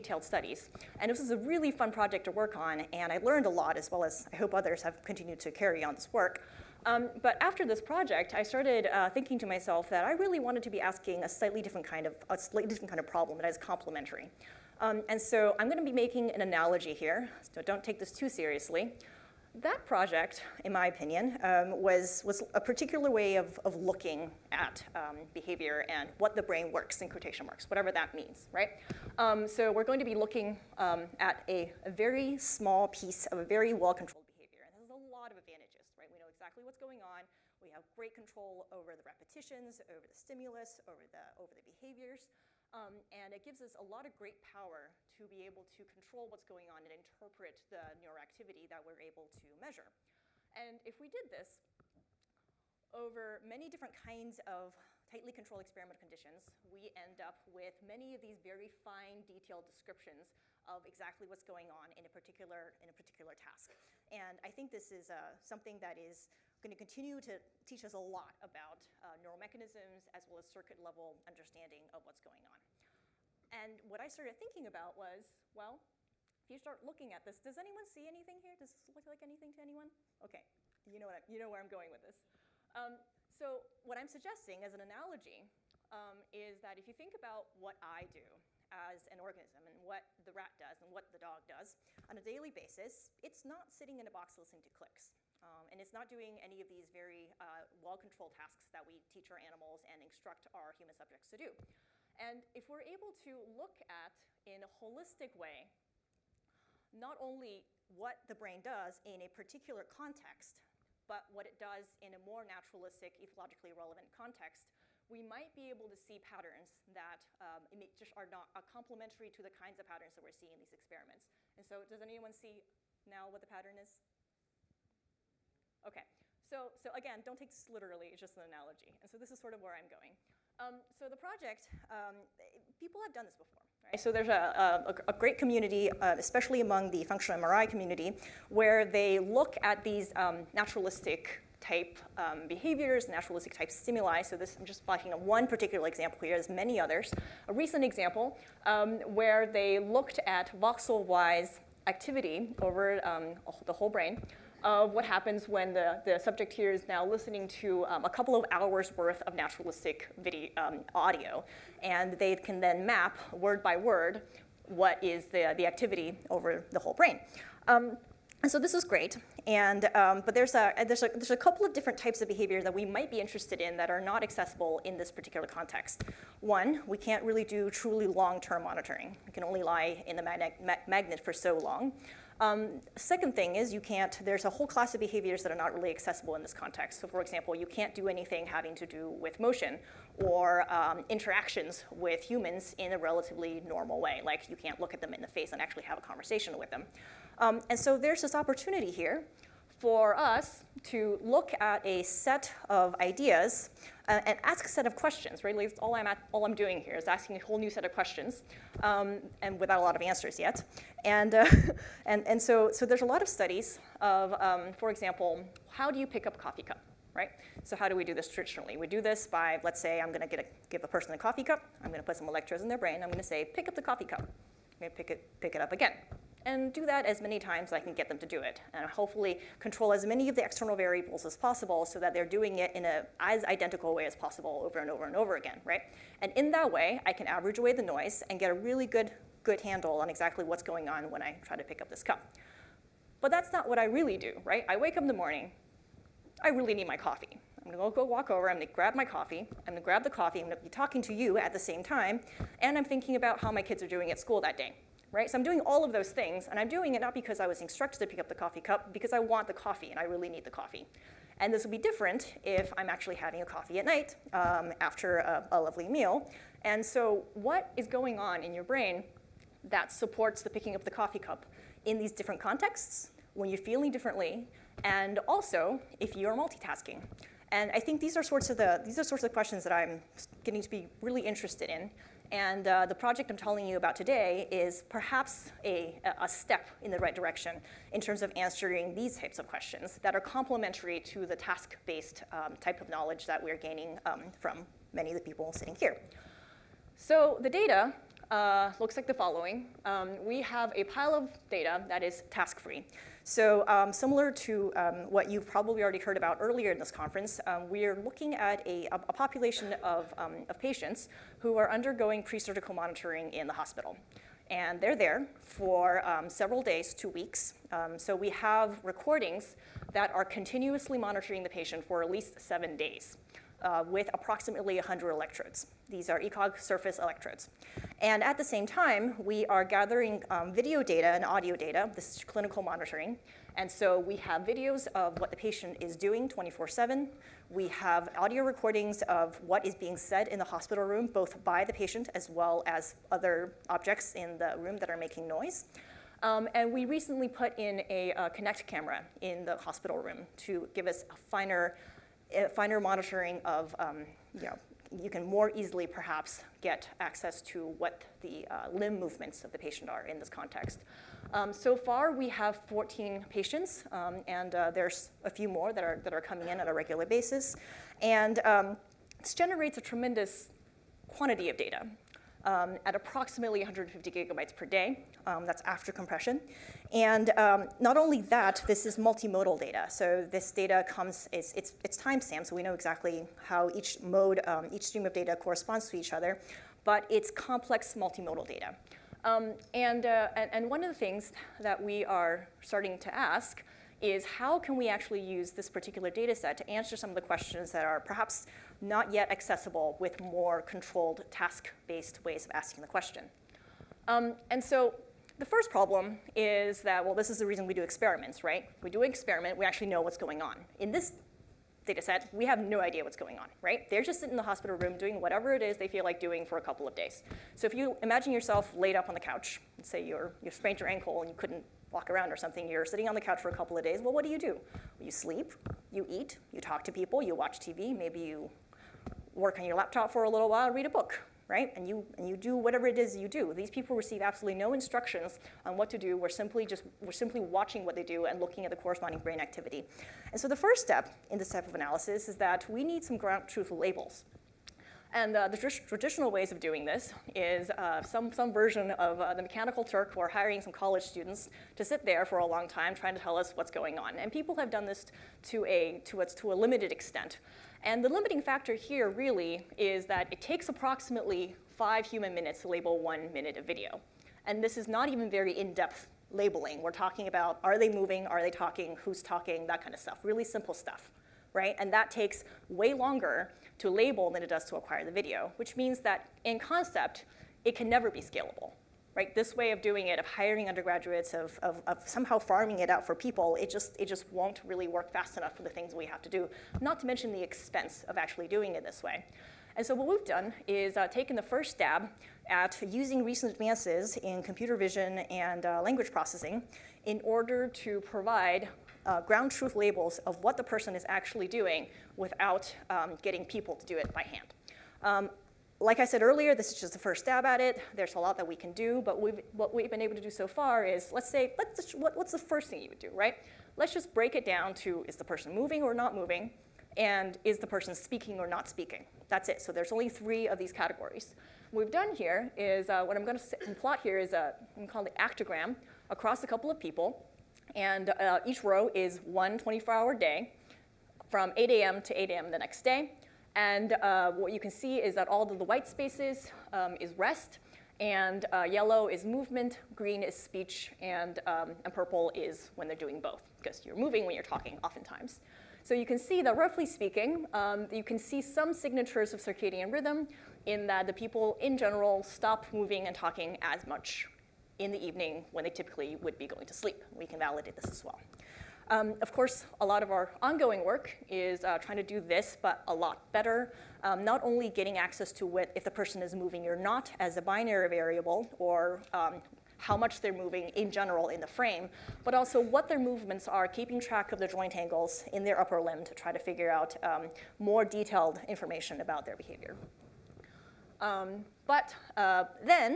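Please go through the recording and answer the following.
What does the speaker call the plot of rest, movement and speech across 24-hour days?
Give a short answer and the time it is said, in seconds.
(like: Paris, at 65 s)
Actogram, at 525 s.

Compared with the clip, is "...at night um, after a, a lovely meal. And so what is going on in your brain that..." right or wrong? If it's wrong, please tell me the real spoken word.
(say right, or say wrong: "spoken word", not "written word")
right.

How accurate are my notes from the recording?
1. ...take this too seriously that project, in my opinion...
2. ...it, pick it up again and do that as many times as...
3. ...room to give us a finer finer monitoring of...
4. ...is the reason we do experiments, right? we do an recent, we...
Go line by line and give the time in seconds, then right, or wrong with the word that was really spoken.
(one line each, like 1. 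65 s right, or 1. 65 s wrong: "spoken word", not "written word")
1. 17 s right
2. 225 s right
3. 349 s right
4. 407 s wrong: "experiment", not "recent".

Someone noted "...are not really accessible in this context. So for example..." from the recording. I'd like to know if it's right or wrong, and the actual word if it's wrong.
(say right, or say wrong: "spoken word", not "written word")
right.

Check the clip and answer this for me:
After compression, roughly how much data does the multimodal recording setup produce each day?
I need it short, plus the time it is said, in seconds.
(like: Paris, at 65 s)
150 gigabytes, at 373 s.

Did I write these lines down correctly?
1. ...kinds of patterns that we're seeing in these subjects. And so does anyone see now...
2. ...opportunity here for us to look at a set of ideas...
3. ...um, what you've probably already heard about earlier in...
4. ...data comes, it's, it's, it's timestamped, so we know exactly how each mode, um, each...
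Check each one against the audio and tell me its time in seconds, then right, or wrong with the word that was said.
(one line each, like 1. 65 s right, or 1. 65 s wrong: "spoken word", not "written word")
1. 119 s wrong: "experiments", not "subjects"
2. 198 s right
3. 304 s right
4. 380 s right.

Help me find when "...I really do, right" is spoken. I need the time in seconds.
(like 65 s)
243 s.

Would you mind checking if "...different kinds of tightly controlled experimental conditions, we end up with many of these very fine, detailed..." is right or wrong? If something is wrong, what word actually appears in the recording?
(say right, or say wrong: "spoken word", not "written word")
right.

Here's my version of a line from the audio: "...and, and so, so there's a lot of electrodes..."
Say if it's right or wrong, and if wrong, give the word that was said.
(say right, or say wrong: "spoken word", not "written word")
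wrong: "studies", not "electrodes".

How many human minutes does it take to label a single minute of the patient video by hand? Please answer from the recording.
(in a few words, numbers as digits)
5.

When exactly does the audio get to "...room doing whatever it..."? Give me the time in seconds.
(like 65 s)
414 s.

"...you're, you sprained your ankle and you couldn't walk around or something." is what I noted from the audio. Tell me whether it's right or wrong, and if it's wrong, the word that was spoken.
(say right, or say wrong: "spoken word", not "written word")
right.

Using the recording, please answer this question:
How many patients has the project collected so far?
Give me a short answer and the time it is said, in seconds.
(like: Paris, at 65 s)
14, at 362 s.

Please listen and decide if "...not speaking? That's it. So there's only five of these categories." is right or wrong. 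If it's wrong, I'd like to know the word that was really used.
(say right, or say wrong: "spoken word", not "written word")
wrong: "three", not "five".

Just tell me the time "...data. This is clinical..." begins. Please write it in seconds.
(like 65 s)
331 s.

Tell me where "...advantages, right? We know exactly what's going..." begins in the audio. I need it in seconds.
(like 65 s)
35 s.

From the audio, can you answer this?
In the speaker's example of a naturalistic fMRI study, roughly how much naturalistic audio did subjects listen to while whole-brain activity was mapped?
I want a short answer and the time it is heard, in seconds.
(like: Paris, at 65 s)
A couple of hours, at 158 s.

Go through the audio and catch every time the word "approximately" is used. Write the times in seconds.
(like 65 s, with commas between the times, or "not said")
324 s, 372 s, 460 s.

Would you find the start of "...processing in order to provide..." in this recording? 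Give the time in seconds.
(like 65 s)
496 s.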